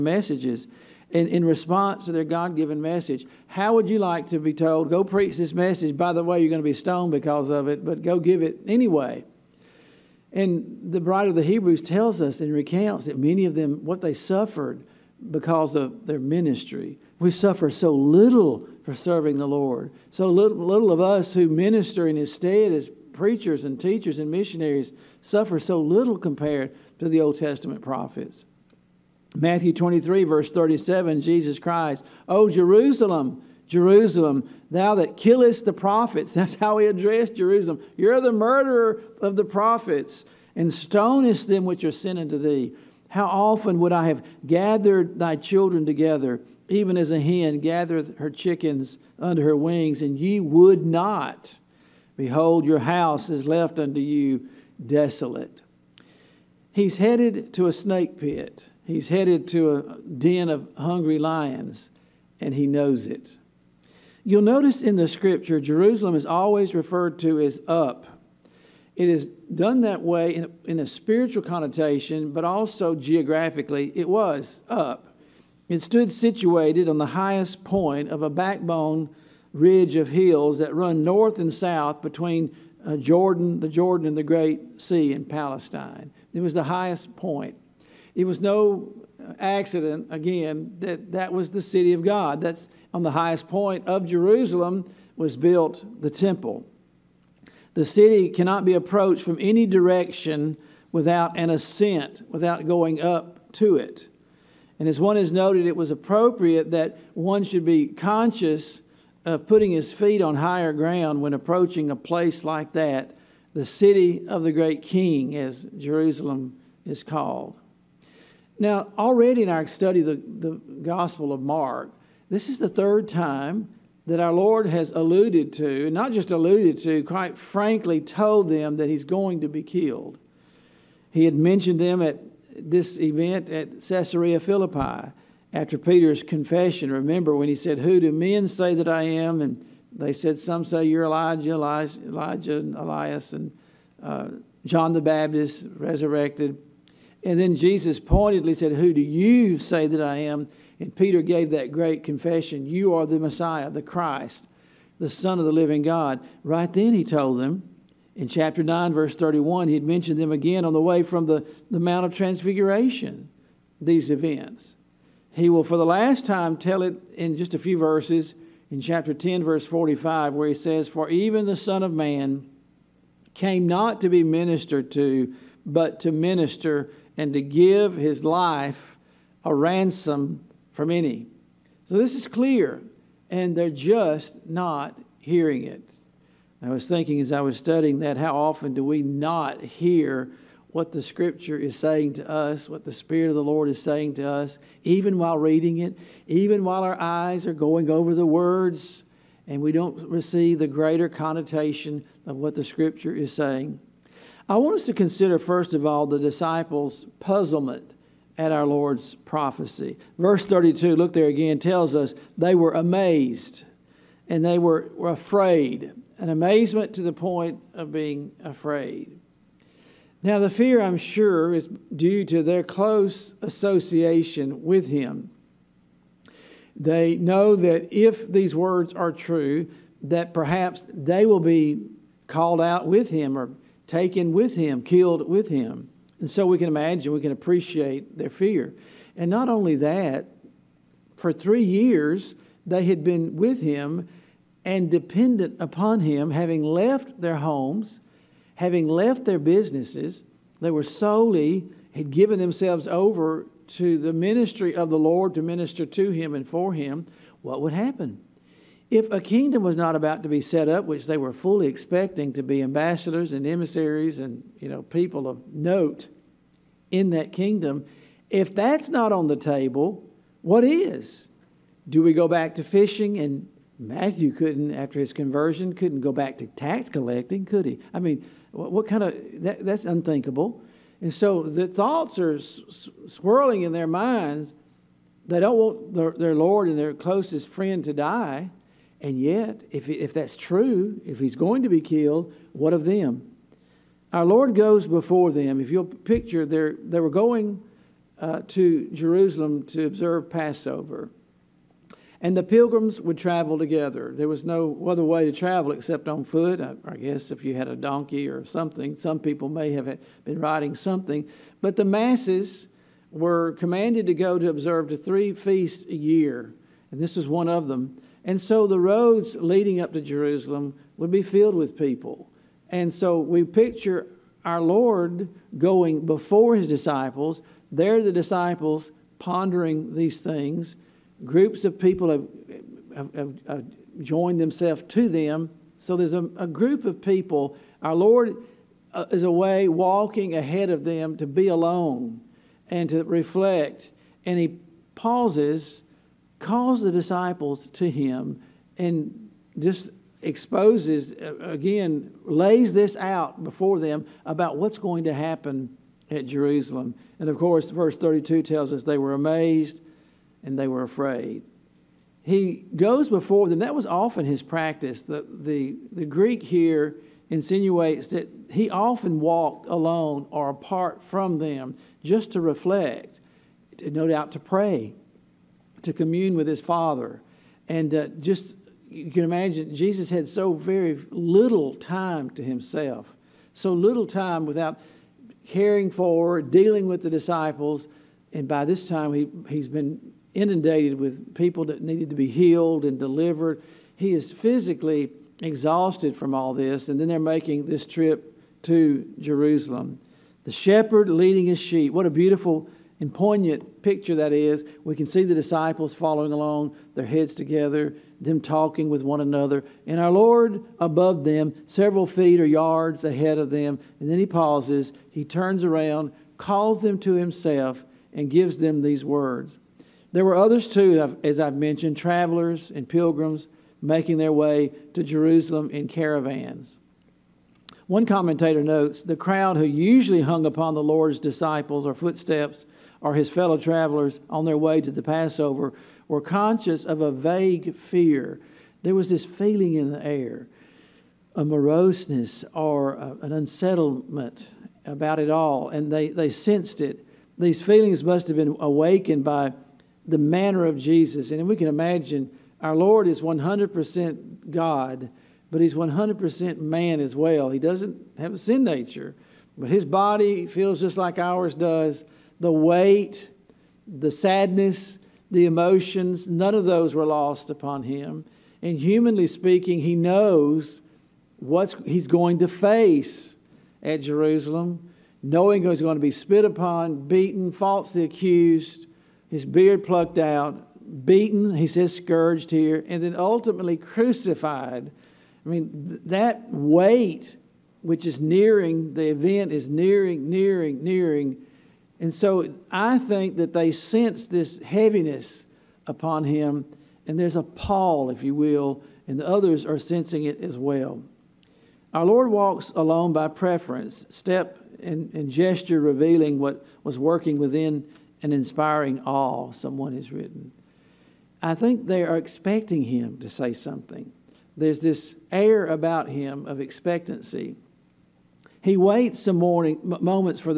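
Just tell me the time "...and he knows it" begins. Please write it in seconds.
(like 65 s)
62 s.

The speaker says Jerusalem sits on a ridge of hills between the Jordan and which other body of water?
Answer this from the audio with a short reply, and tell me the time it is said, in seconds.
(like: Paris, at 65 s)
the Great Sea, at 84 s.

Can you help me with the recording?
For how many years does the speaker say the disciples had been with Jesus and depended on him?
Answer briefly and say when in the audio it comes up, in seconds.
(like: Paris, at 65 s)
3, at 241 s.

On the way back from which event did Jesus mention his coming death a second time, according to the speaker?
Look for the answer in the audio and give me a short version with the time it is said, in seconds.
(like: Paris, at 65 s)
the Mount of Transfiguration, at 161 s.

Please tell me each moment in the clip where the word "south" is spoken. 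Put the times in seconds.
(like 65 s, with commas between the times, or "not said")
81 s.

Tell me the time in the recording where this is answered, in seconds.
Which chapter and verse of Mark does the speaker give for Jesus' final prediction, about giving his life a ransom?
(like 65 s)
168 s.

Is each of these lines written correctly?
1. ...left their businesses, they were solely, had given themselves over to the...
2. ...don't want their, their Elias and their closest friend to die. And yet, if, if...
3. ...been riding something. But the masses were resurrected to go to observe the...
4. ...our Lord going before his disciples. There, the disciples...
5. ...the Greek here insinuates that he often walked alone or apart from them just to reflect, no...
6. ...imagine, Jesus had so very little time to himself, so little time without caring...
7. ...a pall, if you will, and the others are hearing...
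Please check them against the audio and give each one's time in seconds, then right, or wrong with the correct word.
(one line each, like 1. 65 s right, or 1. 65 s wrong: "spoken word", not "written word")
1. 248 s right
2. 285 s wrong: "Lord", not "Elias"
3. 310 s wrong: "commanded", not "resurrected"
4. 324 s right
5. 365 s right
6. 379 s right
7. 497 s wrong: "sensing", not "hearing".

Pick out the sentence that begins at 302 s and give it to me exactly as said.
And the pilgrims would travel together.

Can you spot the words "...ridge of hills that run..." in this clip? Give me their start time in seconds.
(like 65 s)
79 s.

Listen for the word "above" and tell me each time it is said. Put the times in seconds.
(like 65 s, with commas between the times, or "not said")
410 s.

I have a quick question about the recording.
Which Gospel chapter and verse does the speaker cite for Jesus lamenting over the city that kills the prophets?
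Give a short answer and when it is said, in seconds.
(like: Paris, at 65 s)
Matthew 23:37, at 29 s.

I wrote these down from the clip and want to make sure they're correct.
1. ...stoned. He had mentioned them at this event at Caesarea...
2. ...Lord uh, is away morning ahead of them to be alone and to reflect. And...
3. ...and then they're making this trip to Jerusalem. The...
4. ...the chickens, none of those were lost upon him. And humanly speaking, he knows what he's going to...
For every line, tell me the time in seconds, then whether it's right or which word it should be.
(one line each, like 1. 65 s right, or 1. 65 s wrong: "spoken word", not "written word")
1. 129 s wrong: "killed", not "stoned"
2. 337 s wrong: "walking", not "morning"
3. 396 s right
4. 465 s wrong: "emotions", not "chickens".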